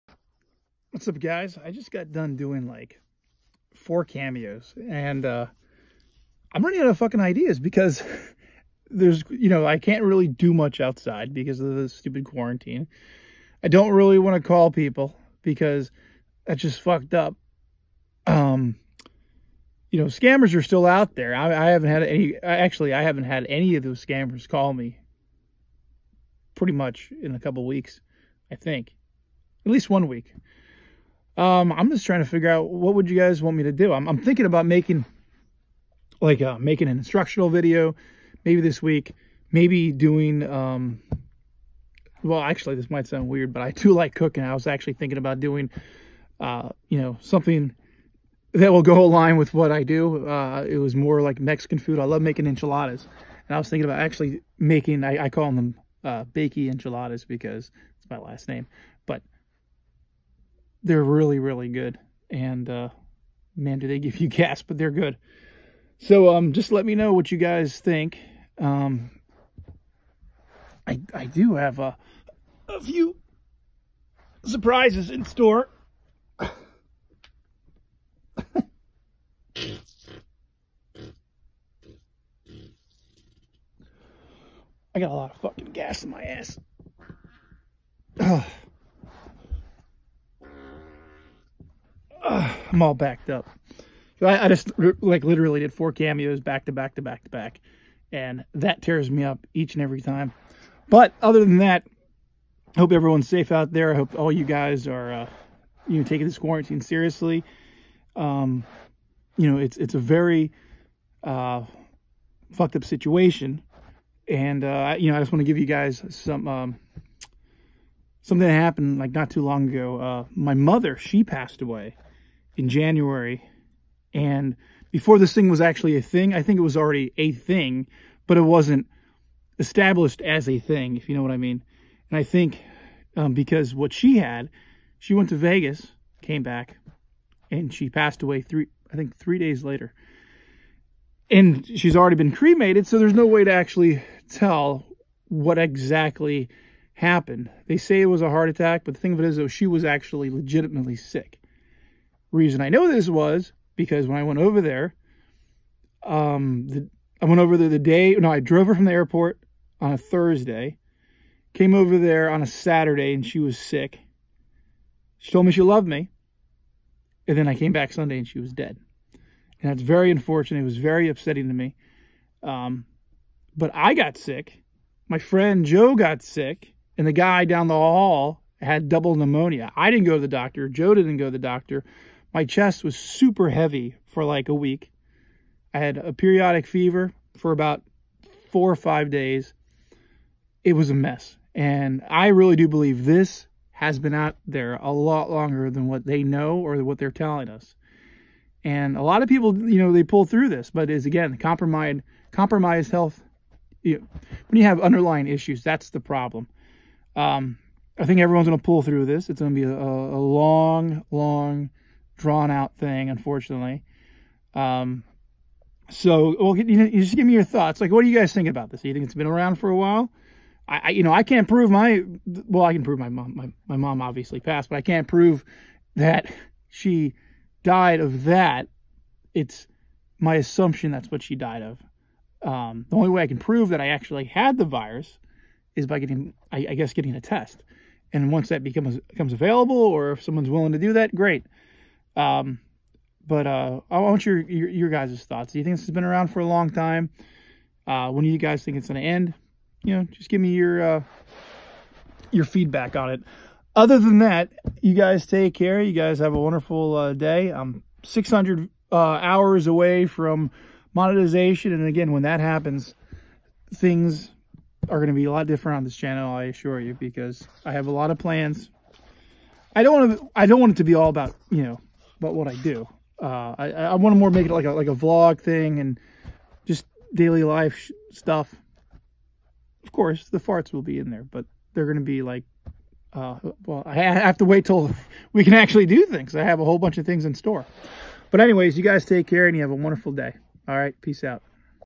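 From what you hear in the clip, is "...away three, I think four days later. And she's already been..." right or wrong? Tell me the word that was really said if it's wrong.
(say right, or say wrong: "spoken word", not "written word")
wrong: "three", not "four".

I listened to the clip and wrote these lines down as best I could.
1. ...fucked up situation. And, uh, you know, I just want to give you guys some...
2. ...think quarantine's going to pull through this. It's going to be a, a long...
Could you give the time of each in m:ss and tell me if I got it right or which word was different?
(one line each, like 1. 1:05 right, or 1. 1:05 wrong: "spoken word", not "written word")
1. 1:52 right
2. 3:28 wrong: "everyone", not "quarantine".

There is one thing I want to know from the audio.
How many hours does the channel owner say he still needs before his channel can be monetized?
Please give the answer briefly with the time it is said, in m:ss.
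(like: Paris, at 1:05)
600, at 4:18.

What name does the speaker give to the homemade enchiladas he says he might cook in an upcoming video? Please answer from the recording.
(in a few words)
Bakey Enchiladas.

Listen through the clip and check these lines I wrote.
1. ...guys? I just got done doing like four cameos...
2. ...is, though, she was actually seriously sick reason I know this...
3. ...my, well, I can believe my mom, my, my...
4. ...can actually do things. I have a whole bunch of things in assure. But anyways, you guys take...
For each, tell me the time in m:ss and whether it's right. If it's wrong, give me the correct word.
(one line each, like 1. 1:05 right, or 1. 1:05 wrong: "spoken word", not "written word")
1. 0:01 right
2. 2:29 wrong: "legitimately", not "seriously"
3. 3:41 wrong: "prove", not "believe"
4. 4:45 wrong: "store", not "assure".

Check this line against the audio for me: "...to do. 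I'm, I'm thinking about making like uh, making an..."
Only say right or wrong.
right.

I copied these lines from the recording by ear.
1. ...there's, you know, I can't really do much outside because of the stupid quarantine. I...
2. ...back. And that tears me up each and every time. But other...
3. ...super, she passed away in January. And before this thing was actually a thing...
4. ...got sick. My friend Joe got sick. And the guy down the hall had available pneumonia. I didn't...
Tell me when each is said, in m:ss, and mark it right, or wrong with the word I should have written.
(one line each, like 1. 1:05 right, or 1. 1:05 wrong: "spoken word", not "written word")
1. 0:08 right
2. 1:37 right
3. 2:00 wrong: "mother", not "super"
4. 2:53 wrong: "double", not "available".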